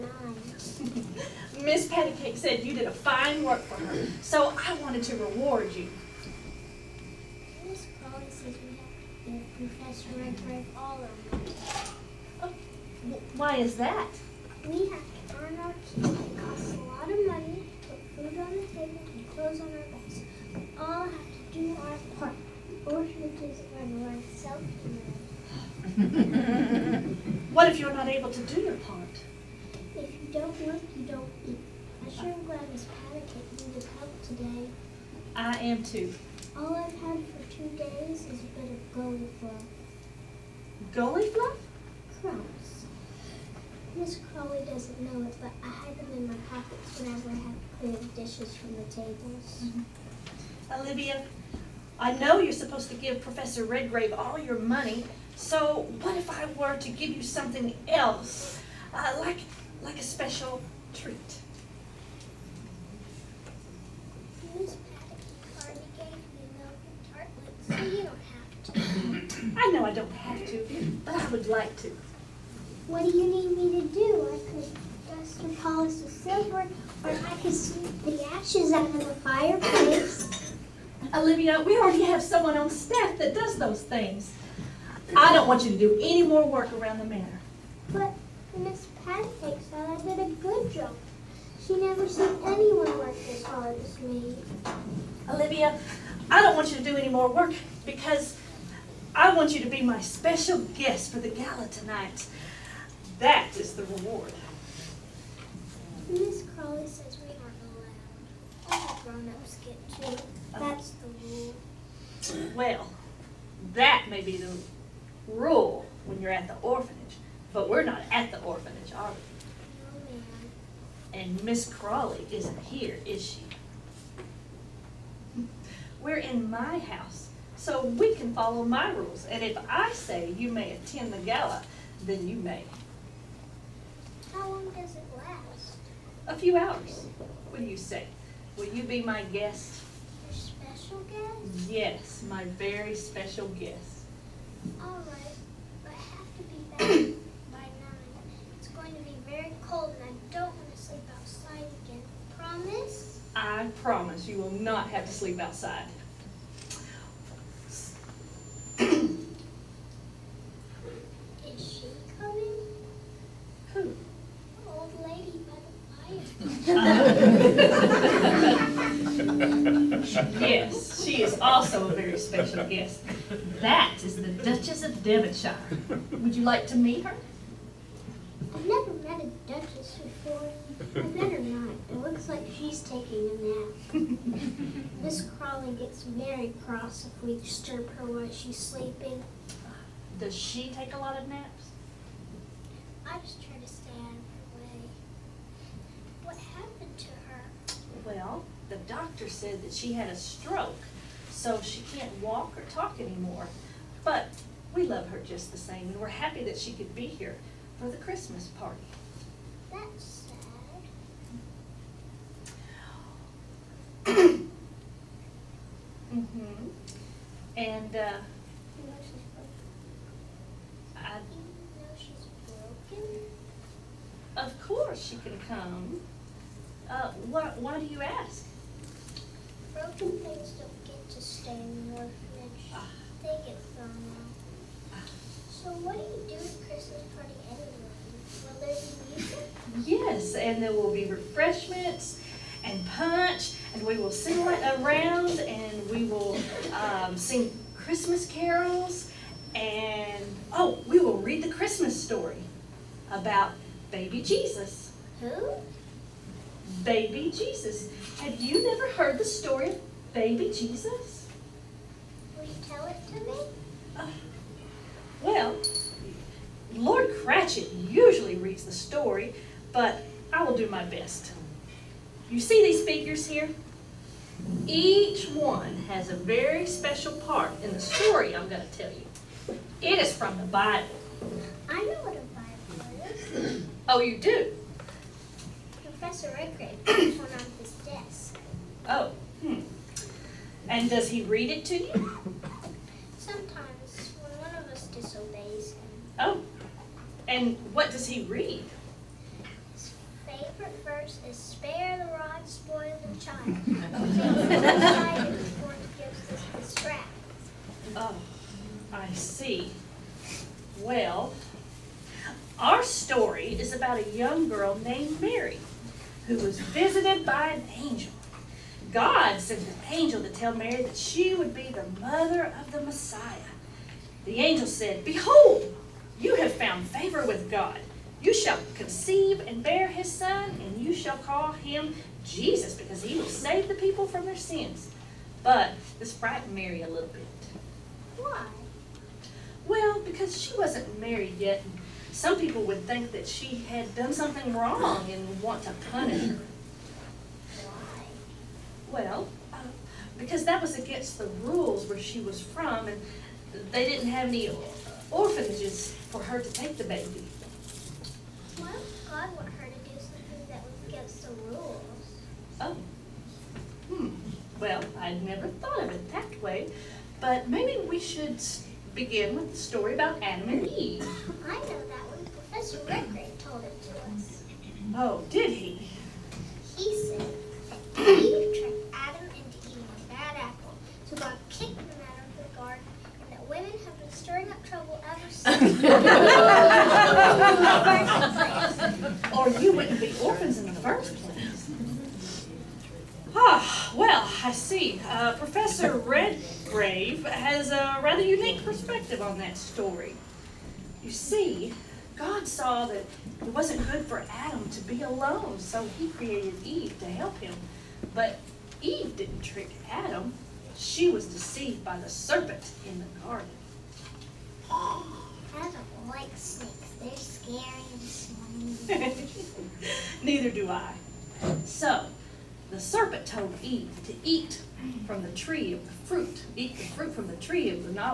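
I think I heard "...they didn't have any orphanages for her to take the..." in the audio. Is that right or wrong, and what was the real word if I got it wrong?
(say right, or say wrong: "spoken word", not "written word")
right.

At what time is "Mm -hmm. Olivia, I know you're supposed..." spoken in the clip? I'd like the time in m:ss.
0:49.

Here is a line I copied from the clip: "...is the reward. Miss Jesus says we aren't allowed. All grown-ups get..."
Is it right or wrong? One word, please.
wrong.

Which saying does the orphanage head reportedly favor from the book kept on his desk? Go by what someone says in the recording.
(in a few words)
Spare the rod, spoil the child.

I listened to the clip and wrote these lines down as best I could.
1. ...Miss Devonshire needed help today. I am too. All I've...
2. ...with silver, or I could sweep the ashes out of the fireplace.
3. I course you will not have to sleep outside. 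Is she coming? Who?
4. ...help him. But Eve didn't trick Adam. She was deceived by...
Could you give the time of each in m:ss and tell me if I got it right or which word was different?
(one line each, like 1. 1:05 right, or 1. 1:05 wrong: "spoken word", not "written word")
1. 0:32 wrong: "Paddock", not "Devonshire"
2. 1:15 right
3. 2:33 wrong: "promise", not "course"
4. 6:47 right.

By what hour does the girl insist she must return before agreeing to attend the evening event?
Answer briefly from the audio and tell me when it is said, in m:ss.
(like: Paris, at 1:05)
9, at 2:27.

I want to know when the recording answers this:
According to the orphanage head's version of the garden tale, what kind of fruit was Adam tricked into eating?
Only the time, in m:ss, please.
6:20.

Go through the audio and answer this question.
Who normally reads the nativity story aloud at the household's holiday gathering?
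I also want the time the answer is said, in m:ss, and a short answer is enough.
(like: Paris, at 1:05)
Lord Cratchit, at 4:26.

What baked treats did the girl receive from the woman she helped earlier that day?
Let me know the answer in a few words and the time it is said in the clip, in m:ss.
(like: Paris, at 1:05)
Milk tartlets, at 1:06.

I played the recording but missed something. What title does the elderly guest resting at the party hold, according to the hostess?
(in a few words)
Duchess of Devonshire.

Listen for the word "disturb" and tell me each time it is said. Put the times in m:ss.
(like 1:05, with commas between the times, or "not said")
3:07.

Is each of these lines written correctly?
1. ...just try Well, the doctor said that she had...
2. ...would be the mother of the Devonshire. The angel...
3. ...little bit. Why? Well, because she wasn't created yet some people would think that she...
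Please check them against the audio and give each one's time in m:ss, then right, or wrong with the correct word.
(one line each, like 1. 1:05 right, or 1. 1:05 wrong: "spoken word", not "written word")
1. 3:13 right
2. 5:21 wrong: "Messiah", not "Devonshire"
3. 5:36 wrong: "married", not "created".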